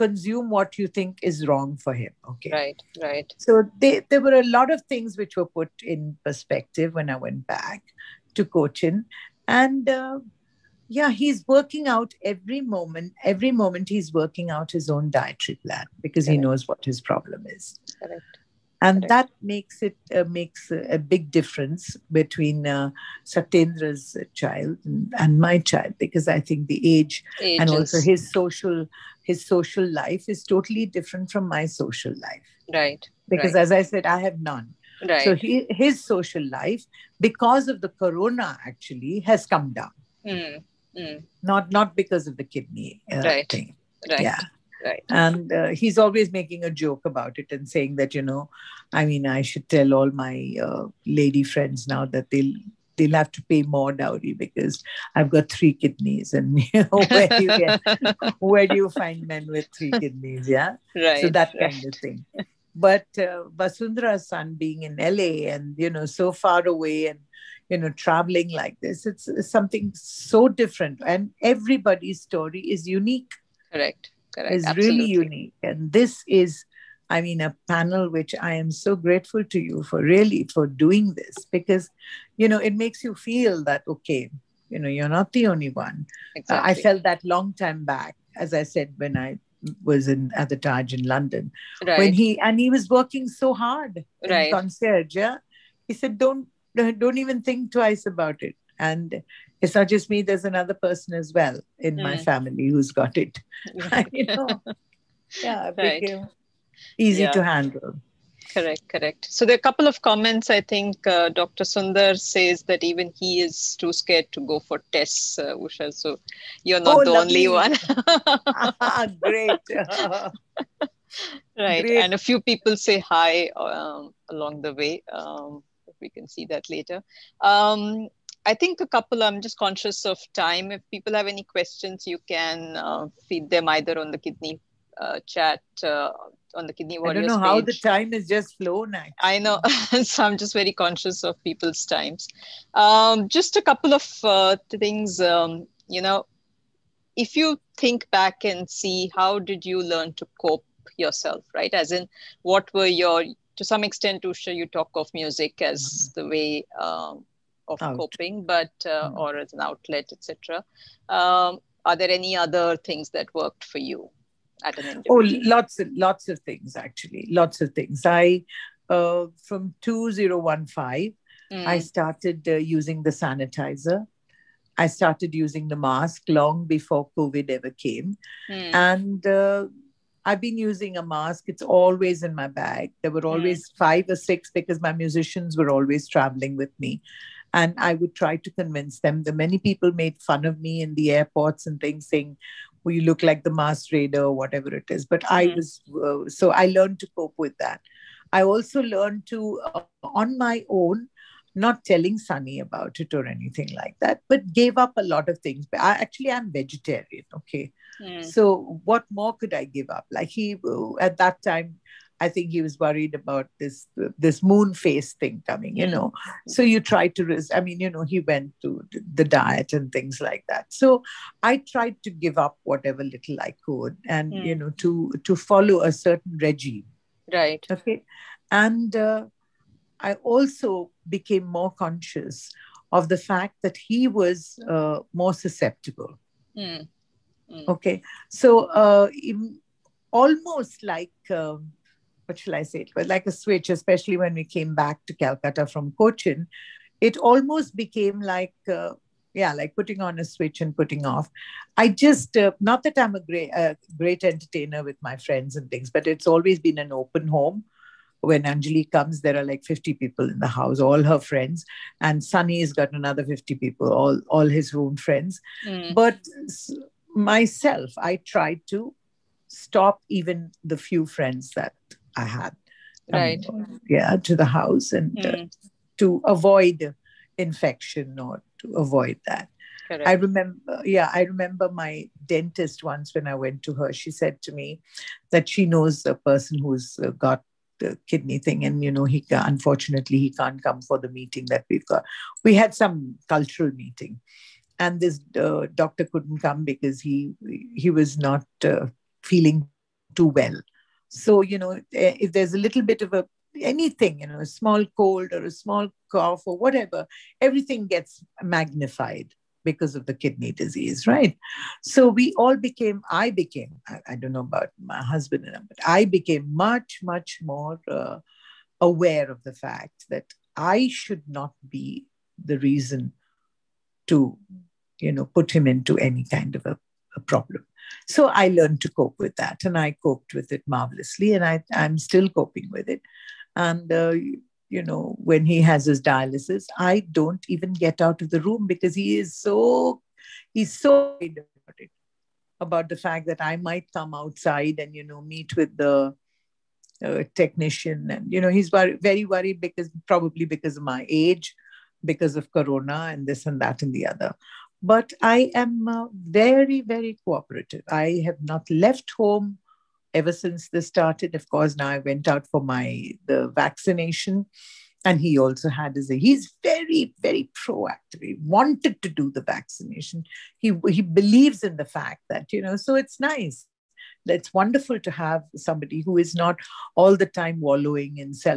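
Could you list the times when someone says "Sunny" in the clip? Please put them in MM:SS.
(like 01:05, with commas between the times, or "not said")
03:22, 04:22.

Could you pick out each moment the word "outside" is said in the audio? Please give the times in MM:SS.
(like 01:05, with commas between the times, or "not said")
05:44.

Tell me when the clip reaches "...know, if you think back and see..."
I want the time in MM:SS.
02:26.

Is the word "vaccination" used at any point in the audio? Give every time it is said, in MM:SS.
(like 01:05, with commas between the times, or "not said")
06:03, 06:09.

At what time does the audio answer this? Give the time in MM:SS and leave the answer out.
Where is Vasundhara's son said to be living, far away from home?
01:04.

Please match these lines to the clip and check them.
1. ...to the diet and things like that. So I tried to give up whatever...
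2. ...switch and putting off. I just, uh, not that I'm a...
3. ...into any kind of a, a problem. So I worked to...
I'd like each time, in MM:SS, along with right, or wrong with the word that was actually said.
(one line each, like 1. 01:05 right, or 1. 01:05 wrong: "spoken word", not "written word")
1. 03:38 right
2. 04:10 right
3. 05:25 wrong: "learned", not "worked".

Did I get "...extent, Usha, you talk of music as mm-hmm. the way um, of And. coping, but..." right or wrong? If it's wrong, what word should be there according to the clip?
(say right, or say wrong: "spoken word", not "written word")
wrong: "Out", not "And".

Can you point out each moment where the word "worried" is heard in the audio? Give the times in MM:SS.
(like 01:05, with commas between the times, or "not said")
03:32, 05:49.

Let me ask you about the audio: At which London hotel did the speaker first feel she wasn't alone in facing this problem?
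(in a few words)
the Taj.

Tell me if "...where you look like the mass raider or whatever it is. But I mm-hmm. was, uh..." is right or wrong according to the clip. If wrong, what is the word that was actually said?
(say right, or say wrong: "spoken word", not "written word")
right.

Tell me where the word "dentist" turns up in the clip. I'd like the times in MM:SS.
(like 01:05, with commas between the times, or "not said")
04:42.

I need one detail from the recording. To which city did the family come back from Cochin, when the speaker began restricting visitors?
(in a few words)
Calcutta.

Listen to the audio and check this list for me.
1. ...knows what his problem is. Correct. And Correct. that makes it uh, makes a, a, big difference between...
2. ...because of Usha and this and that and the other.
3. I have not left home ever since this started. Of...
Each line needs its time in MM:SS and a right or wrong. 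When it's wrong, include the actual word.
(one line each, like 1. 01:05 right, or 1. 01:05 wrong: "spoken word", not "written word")
1. 00:16 right
2. 05:52 wrong: "Corona", not "Usha"
3. 05:57 right.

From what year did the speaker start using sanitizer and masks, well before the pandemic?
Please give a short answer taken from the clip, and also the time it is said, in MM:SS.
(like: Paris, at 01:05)
2015, at 02:49.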